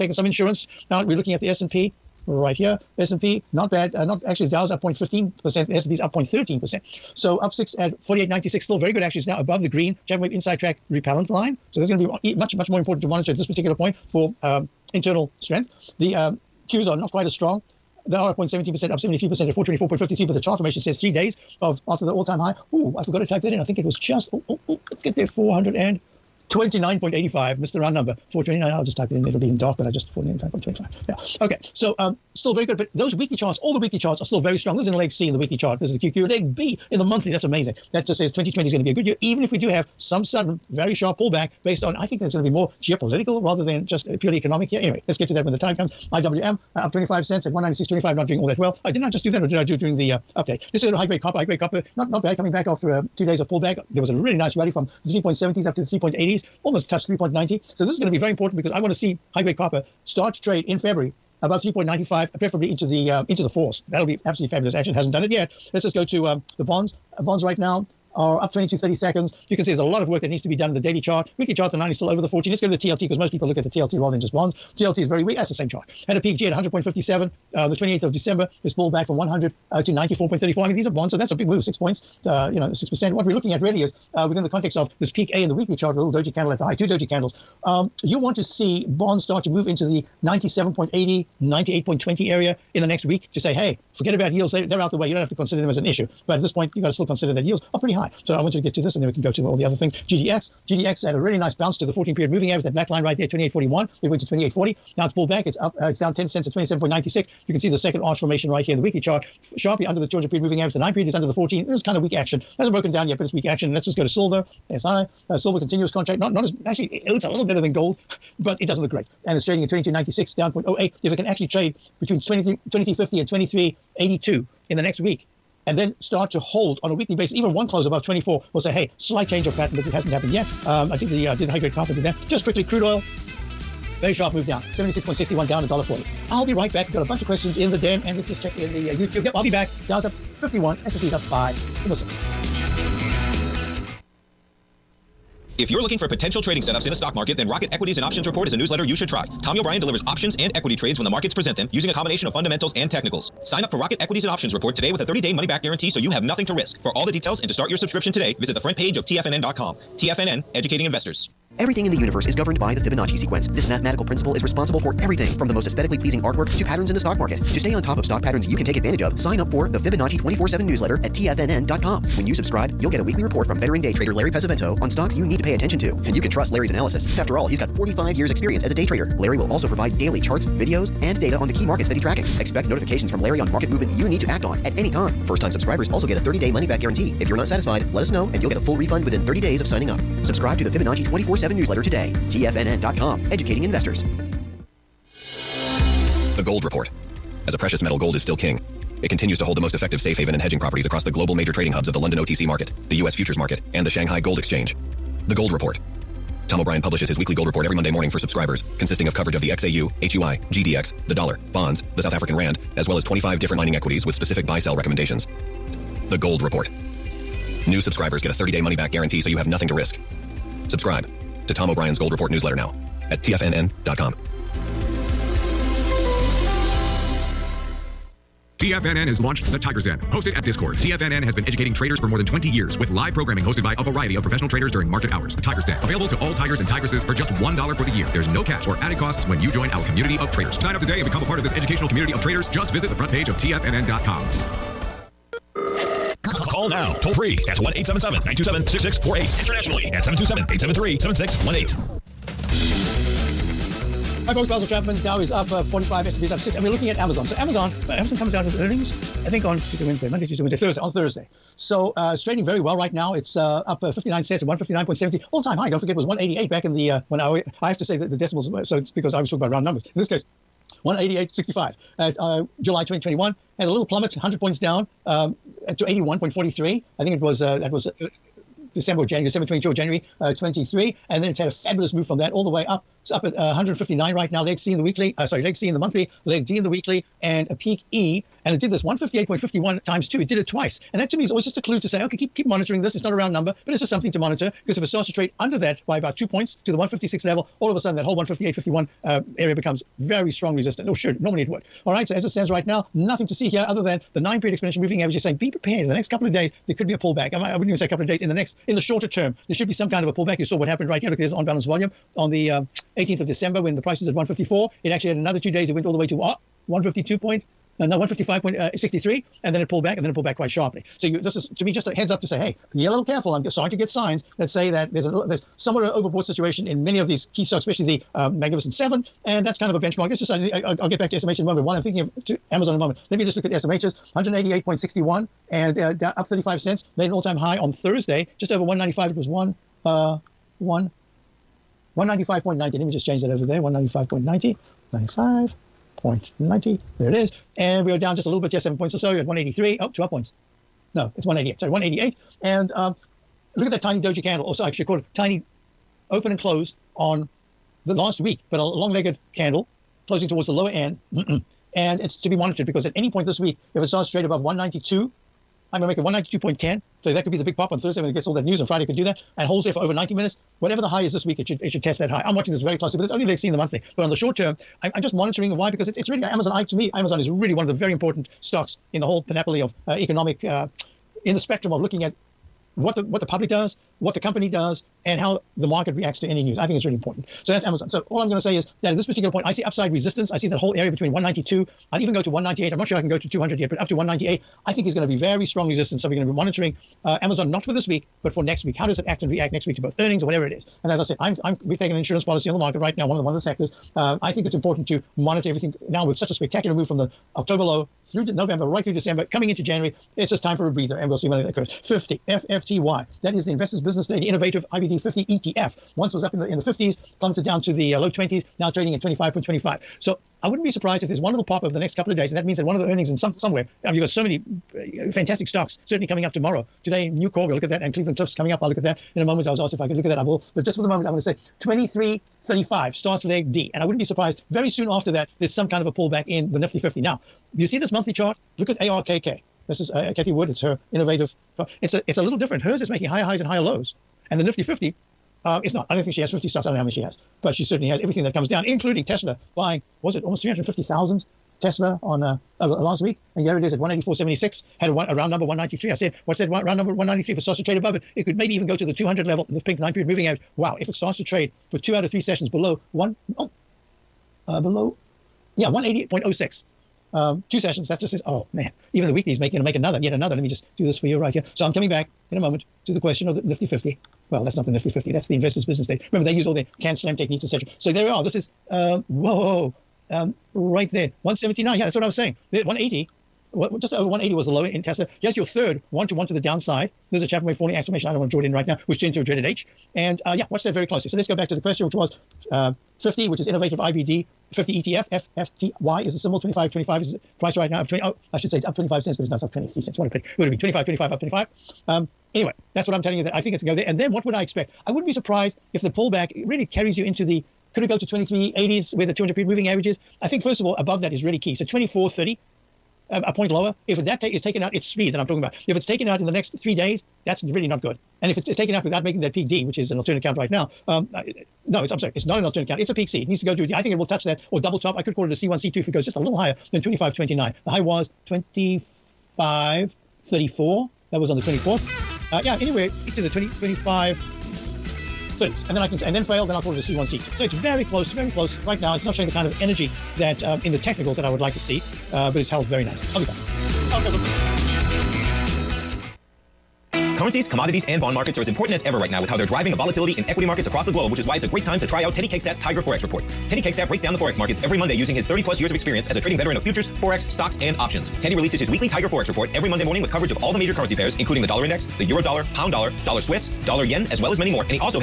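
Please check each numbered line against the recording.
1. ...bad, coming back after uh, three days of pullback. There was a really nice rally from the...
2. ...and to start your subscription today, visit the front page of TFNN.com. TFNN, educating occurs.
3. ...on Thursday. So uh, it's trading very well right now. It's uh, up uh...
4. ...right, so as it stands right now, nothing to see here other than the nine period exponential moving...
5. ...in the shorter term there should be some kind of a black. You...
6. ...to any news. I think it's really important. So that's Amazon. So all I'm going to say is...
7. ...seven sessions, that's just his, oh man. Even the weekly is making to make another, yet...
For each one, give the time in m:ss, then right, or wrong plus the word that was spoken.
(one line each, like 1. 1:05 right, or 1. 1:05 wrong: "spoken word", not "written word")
1. 0:52 wrong: "two", not "three"
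2. 2:37 wrong: "investors", not "occurs"
3. 4:20 right
4. 5:01 right
5. 5:08 wrong: "pullback", not "black"
6. 6:26 right
7. 7:47 wrong: "two", not "seven".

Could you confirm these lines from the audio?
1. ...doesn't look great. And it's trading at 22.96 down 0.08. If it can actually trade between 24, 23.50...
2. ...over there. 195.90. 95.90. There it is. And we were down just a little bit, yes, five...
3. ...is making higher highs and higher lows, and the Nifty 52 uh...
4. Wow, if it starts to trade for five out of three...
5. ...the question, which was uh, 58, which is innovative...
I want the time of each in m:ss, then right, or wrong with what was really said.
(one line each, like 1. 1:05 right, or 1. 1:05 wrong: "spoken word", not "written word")
1. 1:58 wrong: "23", not "24"
2. 5:43 wrong: "seven", not "five"
3. 7:22 wrong: "50", not "52"
4. 7:40 wrong: "two", not "five"
5. 8:11 wrong: "50", not "58".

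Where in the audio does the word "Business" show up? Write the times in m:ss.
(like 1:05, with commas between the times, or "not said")
6:53, 7:55.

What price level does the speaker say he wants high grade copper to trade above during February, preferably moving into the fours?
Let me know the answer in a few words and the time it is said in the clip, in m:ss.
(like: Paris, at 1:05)
3.95, at 1:01.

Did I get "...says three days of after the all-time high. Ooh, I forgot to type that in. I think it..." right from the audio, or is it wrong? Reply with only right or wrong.
right.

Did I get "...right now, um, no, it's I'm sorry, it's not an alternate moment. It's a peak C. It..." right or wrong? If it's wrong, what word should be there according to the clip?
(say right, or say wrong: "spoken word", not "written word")
wrong: "count", not "moment".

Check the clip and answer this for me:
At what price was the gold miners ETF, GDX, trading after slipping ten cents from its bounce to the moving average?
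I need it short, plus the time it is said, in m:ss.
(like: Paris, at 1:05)
27.96, at 1:46.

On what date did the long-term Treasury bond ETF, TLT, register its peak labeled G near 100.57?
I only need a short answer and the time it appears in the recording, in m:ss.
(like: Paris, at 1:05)
28th of December, at 1:17.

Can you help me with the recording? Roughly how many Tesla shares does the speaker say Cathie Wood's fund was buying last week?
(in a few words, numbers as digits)
350,000.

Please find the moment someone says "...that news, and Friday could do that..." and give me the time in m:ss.
6:08.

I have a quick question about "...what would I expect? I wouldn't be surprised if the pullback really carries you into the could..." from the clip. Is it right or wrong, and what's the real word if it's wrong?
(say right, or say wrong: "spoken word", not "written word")
right.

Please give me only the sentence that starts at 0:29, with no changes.
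It'll be in dark, but I just 495.25.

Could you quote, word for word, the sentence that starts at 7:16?
Now, you see this monthly chart?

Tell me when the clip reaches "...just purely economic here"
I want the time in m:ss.
0:43.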